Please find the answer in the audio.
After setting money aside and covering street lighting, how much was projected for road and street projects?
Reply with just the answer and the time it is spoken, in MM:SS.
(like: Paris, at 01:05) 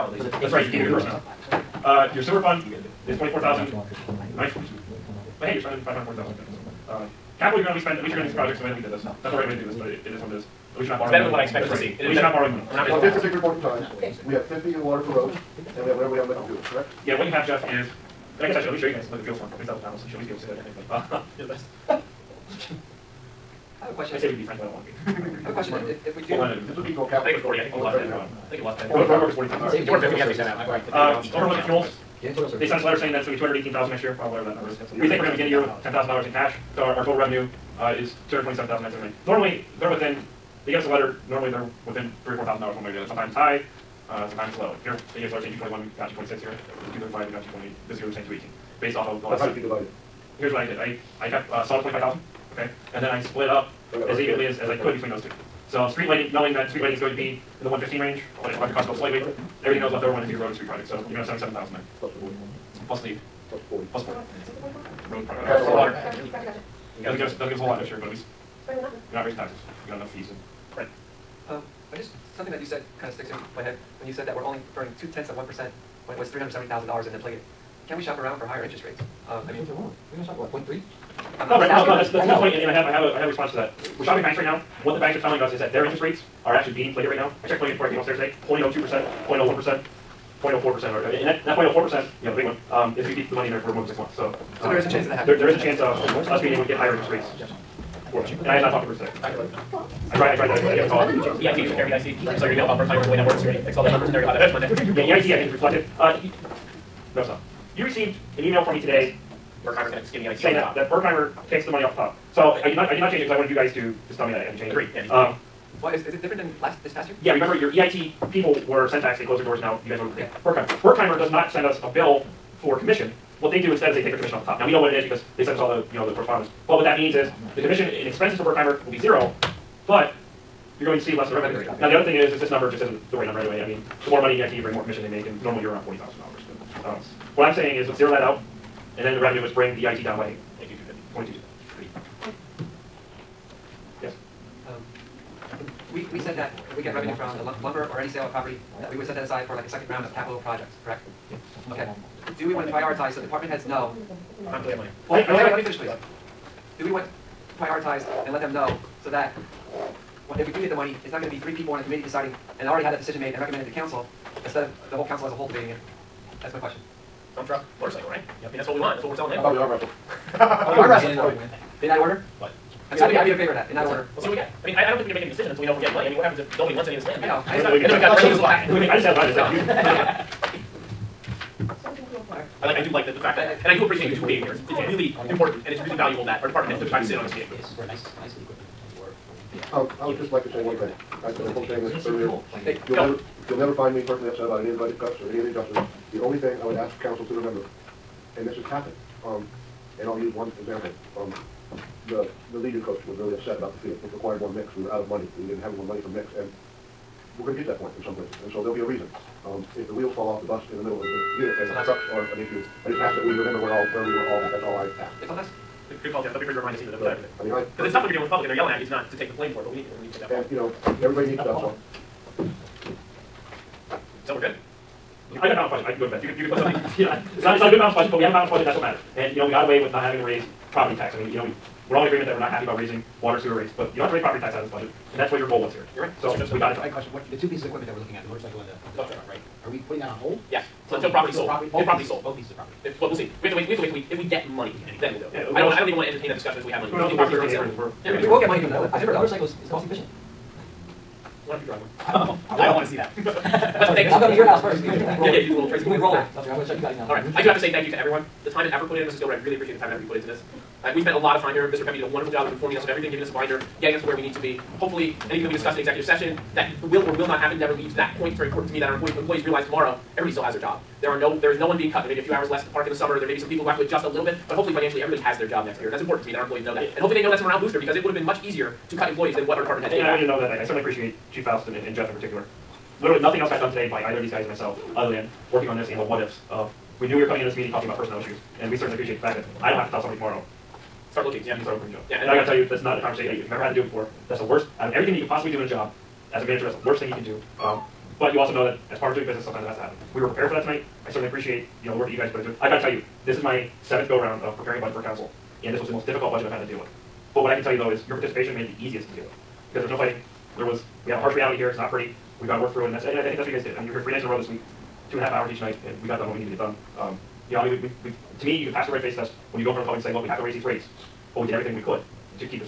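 77,000, at 01:01.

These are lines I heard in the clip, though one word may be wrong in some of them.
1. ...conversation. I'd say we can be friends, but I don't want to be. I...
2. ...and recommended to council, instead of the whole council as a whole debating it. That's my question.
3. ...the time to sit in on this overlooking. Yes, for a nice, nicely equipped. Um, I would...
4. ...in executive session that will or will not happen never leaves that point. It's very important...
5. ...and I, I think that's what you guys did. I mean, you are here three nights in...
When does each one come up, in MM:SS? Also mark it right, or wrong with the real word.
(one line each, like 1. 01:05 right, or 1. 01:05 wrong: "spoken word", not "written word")
1. 00:23 wrong: "question", not "conversation"
2. 02:43 right
3. 03:06 wrong: "meeting", not "overlooking"
4. 04:25 right
5. 05:13 right.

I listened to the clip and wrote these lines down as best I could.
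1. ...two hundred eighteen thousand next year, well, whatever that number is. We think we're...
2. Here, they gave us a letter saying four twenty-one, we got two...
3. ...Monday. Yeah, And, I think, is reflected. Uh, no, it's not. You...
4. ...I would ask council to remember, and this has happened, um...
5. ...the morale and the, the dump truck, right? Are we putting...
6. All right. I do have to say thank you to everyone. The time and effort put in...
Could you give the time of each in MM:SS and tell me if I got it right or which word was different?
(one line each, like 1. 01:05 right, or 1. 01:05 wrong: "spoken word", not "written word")
1. 00:33 right
2. 00:44 wrong: "two", not "four"
3. 01:44 wrong: "EIT", not "And"
4. 03:16 right
5. 03:58 wrong: "motorcycle", not "morale"
6. 04:17 right.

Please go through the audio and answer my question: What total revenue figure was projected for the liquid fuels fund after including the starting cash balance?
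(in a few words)
$227,979.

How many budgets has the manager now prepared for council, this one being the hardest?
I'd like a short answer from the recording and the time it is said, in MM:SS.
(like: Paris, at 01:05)
7, at 05:03.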